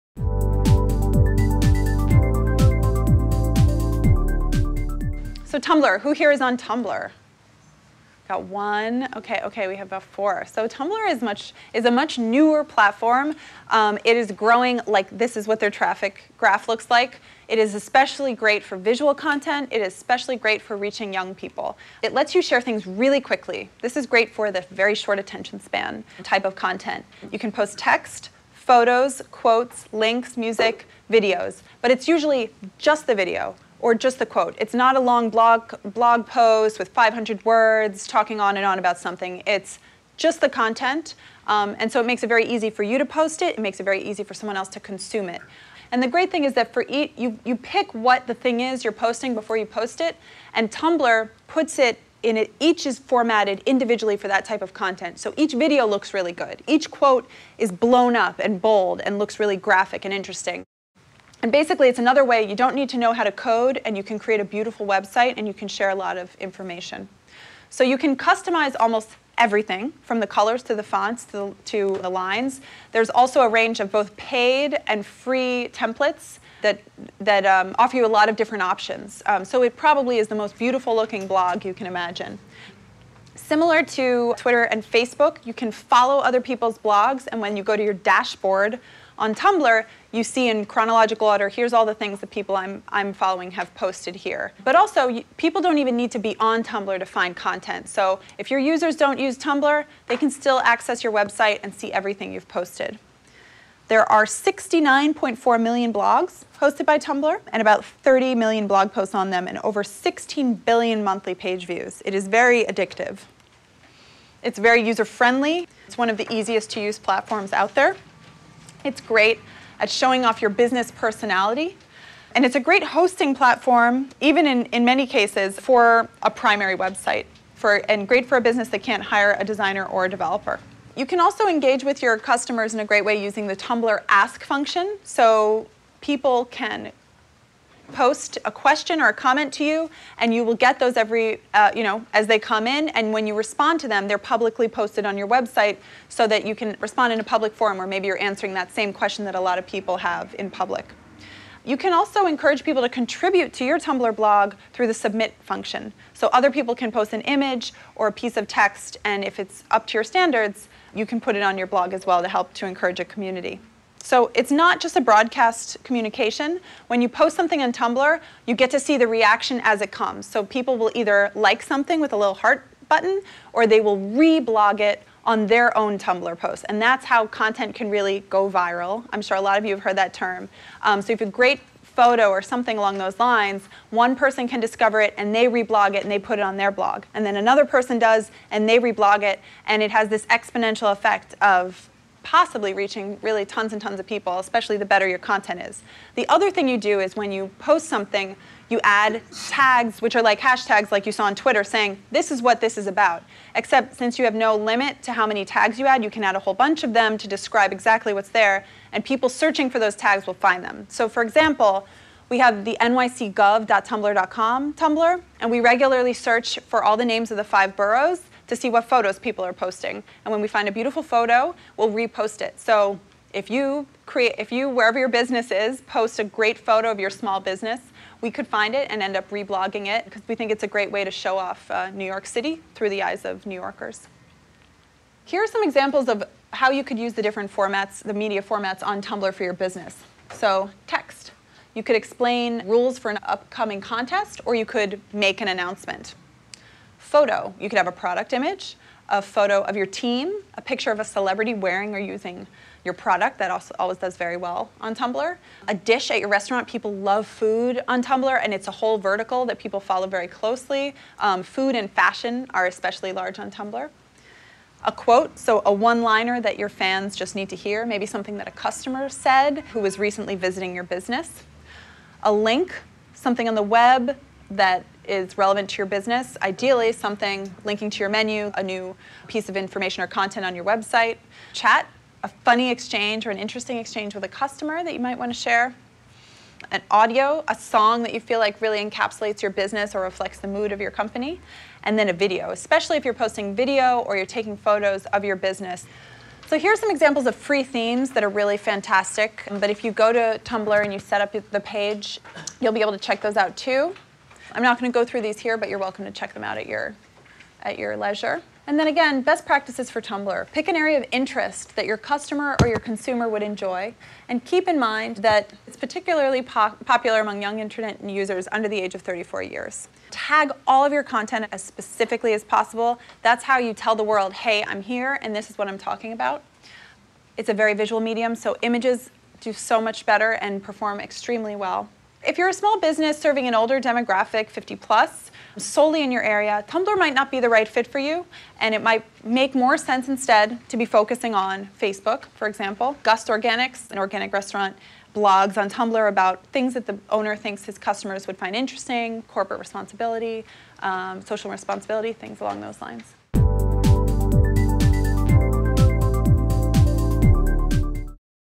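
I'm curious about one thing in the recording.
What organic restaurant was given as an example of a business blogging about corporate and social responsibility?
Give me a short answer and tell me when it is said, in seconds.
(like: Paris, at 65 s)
Gust Organics, at 343 s.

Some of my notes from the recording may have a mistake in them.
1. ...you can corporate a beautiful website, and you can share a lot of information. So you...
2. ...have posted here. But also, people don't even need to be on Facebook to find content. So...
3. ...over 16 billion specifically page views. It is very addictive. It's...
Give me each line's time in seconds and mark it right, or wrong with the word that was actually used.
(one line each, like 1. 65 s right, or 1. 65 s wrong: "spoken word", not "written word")
1. 63 s wrong: "create", not "corporate"
2. 93 s wrong: "Tumblr", not "Facebook"
3. 109 s wrong: "monthly", not "specifically".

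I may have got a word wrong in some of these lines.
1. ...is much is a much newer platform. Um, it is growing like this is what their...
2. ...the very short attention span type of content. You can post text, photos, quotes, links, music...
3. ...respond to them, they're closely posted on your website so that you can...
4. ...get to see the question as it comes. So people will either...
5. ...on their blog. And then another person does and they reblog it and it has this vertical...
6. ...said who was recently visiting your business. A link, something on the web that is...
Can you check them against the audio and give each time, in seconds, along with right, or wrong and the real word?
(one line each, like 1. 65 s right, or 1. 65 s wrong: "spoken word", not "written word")
1. 11 s right
2. 24 s right
3. 143 s wrong: "publicly", not "closely"
4. 168 s wrong: "reaction", not "question"
5. 186 s wrong: "exponential", not "vertical"
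6. 269 s right.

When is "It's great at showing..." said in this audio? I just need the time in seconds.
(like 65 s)
118 s.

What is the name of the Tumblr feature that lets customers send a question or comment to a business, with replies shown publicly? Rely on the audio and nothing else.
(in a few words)
ask function.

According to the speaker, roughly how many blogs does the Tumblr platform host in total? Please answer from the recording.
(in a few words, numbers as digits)
69.4 million.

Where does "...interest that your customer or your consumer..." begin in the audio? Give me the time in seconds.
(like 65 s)
311 s.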